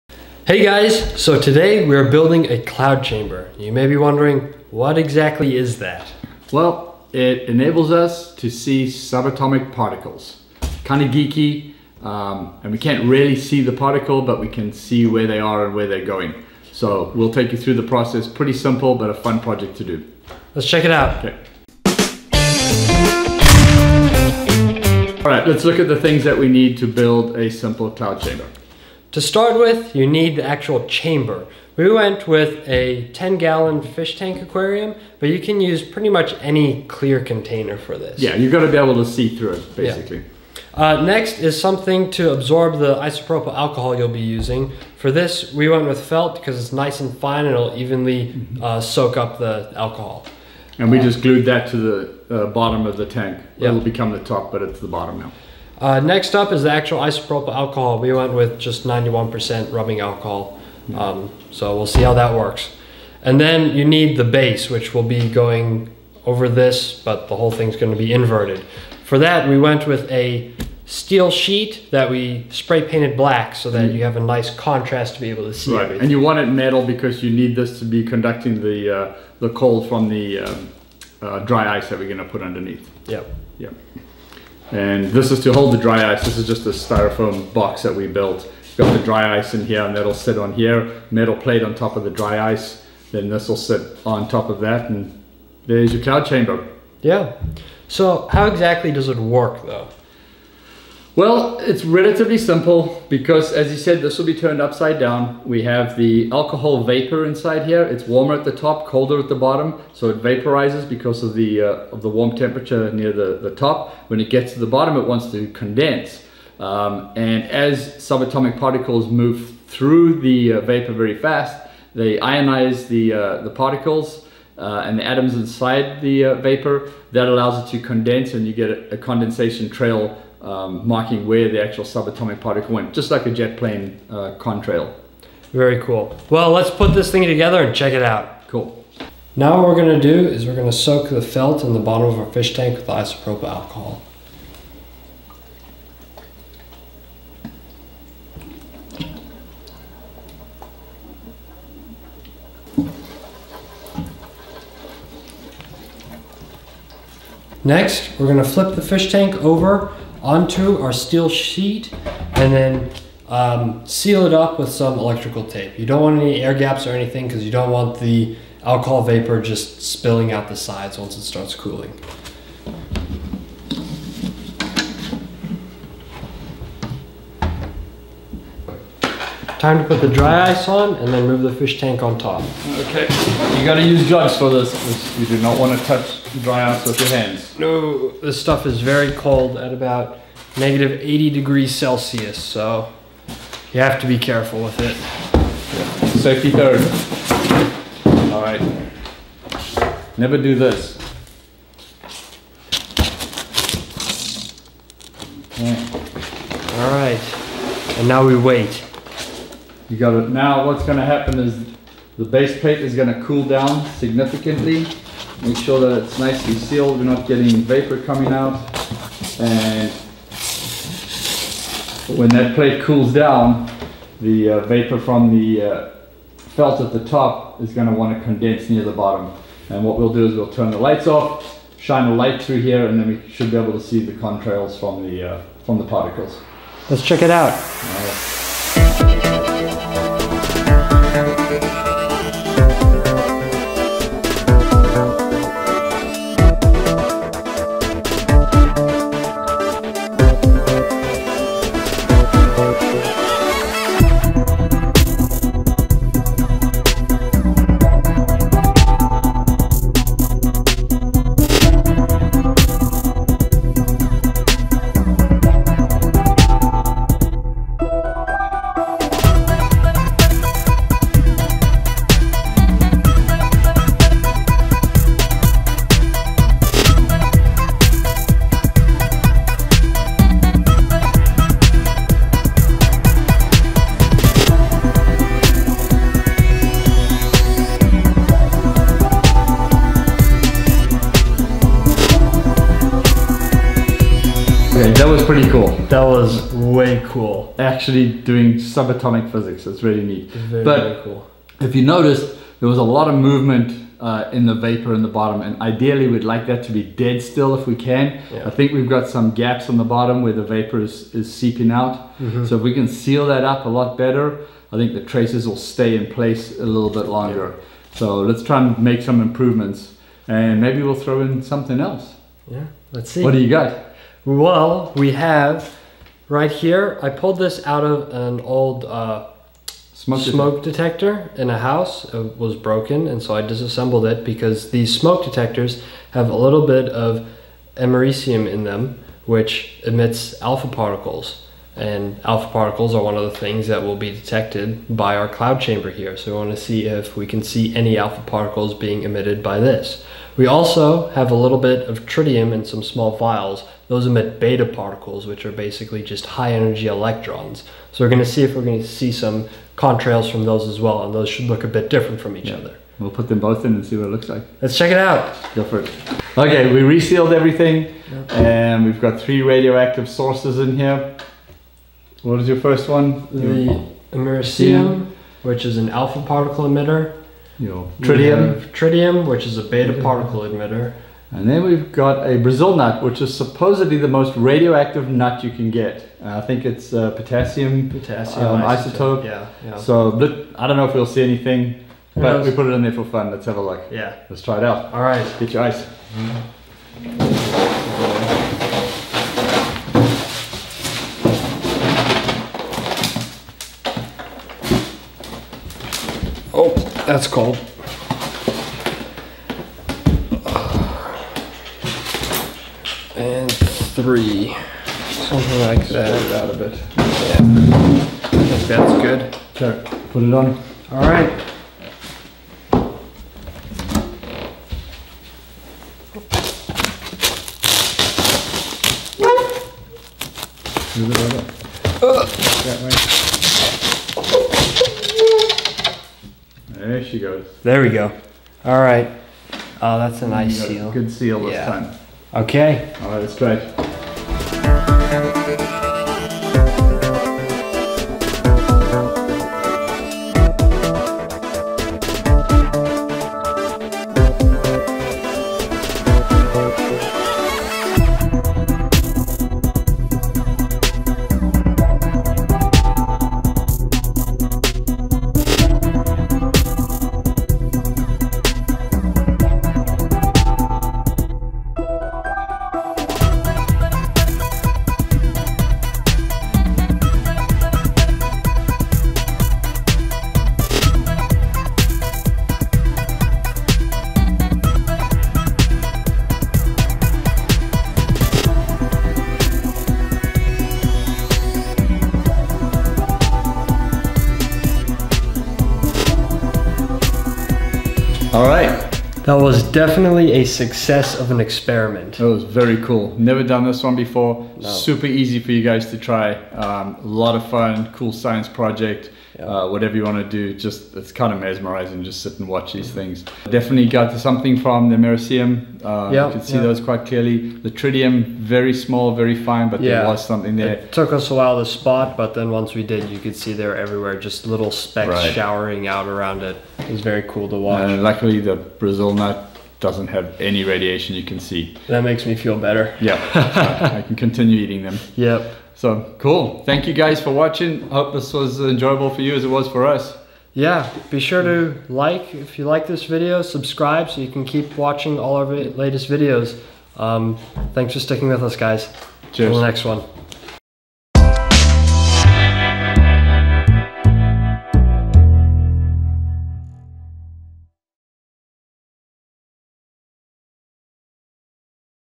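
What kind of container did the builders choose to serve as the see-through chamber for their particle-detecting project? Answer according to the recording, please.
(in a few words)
10 gallon fish tank.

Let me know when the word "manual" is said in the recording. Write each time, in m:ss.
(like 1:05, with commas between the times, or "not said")
not said.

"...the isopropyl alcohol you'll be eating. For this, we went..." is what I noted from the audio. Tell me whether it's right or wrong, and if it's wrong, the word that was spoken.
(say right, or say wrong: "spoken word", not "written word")
wrong: "using", not "eating".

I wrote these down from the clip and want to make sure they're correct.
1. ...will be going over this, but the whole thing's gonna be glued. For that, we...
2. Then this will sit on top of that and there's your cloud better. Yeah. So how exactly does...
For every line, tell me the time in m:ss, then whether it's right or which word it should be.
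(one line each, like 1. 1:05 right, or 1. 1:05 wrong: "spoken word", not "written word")
1. 1:04 wrong: "inverted", not "glued"
2. 1:33 wrong: "chamber", not "better".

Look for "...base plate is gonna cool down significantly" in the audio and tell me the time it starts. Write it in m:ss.
3:32.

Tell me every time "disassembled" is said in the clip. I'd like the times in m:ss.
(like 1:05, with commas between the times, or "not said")
5:33.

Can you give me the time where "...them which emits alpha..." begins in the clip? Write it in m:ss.
5:38.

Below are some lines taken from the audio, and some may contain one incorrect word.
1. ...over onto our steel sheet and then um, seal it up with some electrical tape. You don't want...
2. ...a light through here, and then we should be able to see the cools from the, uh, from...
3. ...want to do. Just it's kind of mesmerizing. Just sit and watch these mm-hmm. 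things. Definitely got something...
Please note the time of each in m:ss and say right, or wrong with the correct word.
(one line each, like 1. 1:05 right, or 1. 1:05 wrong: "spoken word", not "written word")
1. 2:39 right
2. 3:52 wrong: "contrails", not "cools"
3. 8:30 right.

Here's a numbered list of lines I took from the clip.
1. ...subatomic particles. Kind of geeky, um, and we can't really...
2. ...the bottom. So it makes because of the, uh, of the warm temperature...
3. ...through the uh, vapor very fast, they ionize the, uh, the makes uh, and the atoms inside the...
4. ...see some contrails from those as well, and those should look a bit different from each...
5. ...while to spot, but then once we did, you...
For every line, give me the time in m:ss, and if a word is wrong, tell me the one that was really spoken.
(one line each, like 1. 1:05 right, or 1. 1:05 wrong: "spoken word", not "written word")
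1. 0:08 right
2. 1:49 wrong: "vaporizes", not "makes"
3. 1:59 wrong: "particles", not "makes"
4. 5:58 right
5. 8:41 right.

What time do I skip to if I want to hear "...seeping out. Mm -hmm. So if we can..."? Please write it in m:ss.
5:11.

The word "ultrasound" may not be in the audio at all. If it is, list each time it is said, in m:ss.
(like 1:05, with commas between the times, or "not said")
not said.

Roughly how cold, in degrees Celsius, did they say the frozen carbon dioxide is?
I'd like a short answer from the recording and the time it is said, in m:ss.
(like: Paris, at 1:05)
-80, at 3:10.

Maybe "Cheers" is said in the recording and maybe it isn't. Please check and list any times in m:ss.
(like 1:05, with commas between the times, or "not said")
9:09.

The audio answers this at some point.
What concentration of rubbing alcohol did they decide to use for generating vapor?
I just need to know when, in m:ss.
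0:58.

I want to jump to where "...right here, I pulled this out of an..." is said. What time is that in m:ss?
5:26.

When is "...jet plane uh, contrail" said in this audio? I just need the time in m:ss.
2:13.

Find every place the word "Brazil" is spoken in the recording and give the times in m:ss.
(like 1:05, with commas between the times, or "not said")
6:22, 8:48.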